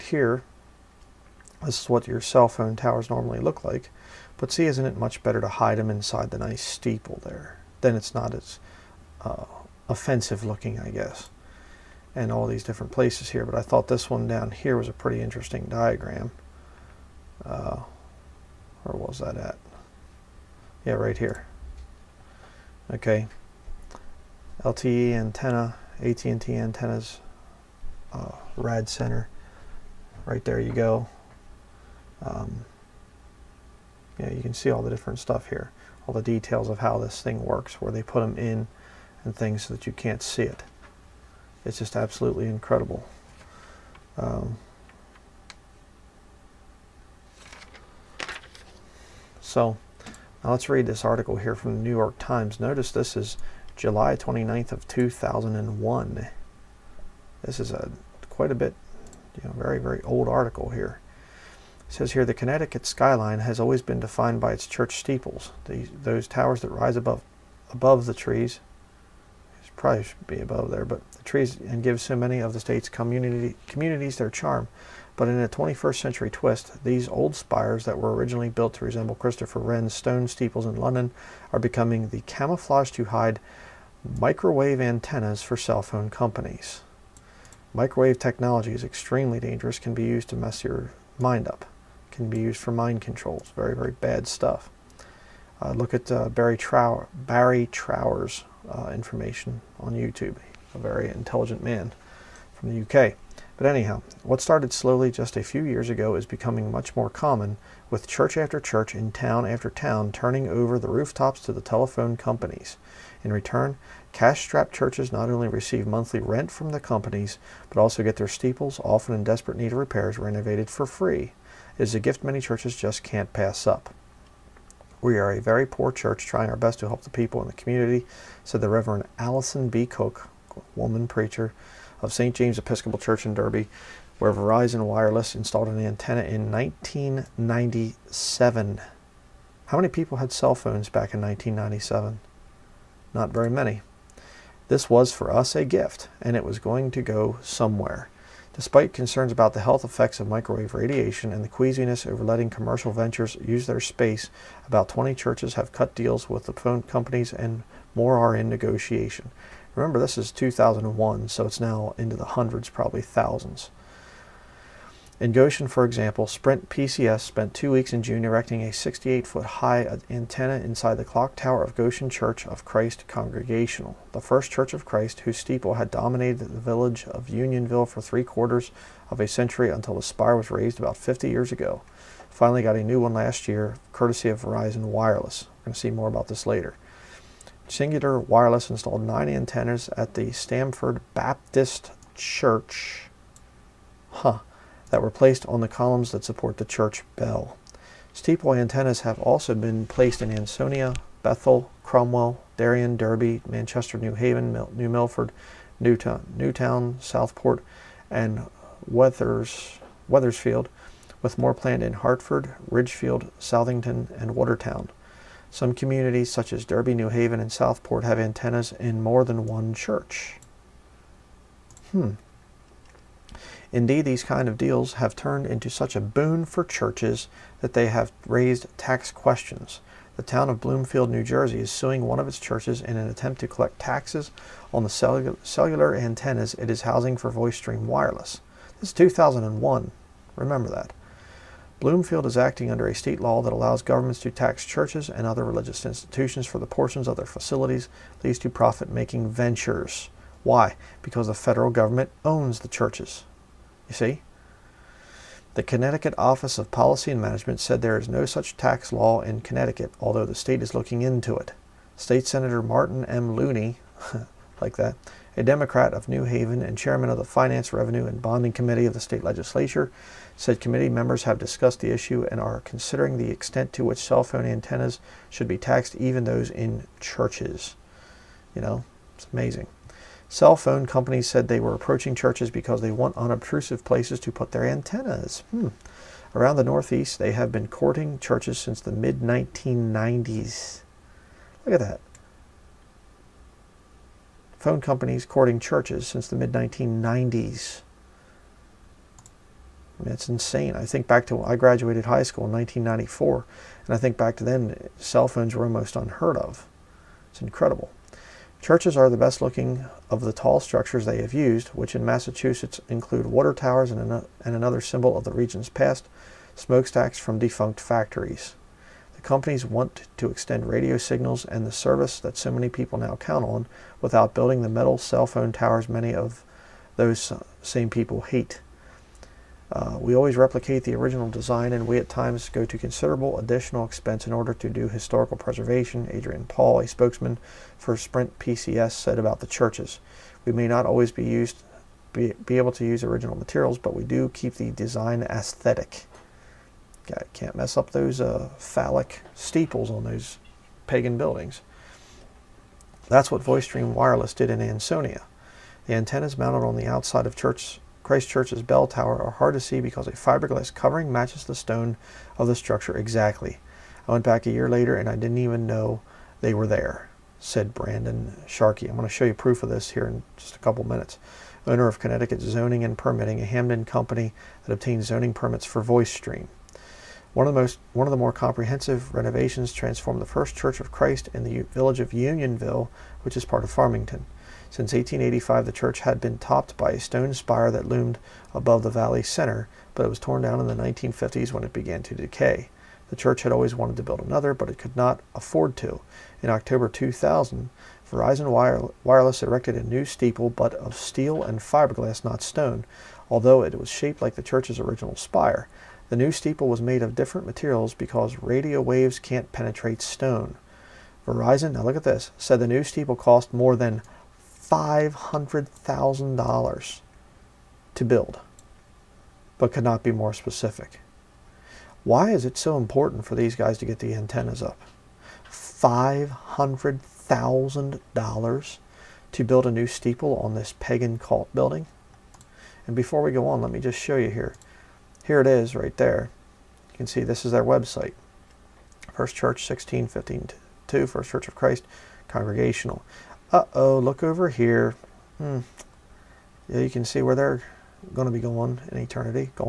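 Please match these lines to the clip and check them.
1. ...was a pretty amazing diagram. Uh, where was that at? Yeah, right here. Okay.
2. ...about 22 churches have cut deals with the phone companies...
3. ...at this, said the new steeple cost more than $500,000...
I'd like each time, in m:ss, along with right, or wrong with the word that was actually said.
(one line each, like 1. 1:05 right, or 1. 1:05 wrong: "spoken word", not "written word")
1. 0:14 wrong: "interesting", not "amazing"
2. 2:34 wrong: "20", not "22"
3. 6:51 right.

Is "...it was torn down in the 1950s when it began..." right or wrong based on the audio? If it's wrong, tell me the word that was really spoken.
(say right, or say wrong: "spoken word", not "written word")
right.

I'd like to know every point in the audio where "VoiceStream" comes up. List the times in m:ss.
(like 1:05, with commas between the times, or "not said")
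3:57, 5:53, 6:15.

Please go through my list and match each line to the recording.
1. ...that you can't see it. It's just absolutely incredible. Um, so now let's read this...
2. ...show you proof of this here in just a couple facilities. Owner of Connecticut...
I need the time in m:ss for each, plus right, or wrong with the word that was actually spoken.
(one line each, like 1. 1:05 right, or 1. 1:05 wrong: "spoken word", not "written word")
1. 0:39 right
2. 6:09 wrong: "minutes", not "facilities".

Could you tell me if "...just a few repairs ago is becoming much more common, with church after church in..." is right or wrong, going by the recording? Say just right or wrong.
wrong.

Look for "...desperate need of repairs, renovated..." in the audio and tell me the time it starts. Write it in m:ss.
1:59.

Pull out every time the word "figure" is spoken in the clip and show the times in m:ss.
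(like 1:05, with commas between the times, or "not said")
not said.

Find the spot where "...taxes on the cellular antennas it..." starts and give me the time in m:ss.
3:53.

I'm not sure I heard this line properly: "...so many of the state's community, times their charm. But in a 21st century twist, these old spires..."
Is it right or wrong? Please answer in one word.
wrong.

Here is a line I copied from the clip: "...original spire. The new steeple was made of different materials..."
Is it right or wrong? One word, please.
right.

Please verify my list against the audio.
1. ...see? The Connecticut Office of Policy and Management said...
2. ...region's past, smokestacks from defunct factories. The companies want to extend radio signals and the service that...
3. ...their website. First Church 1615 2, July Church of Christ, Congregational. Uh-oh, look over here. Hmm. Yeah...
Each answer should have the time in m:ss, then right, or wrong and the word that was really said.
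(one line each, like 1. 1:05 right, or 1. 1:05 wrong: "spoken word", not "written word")
1. 4:14 right
2. 5:15 right
3. 7:17 wrong: "First", not "July".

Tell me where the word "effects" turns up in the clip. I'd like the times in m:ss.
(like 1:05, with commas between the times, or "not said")
2:29.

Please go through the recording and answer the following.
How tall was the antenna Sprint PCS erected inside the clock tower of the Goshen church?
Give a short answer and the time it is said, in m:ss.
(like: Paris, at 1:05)
68 feet, at 2:48.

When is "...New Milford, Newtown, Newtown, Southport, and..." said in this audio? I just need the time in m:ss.
3:24.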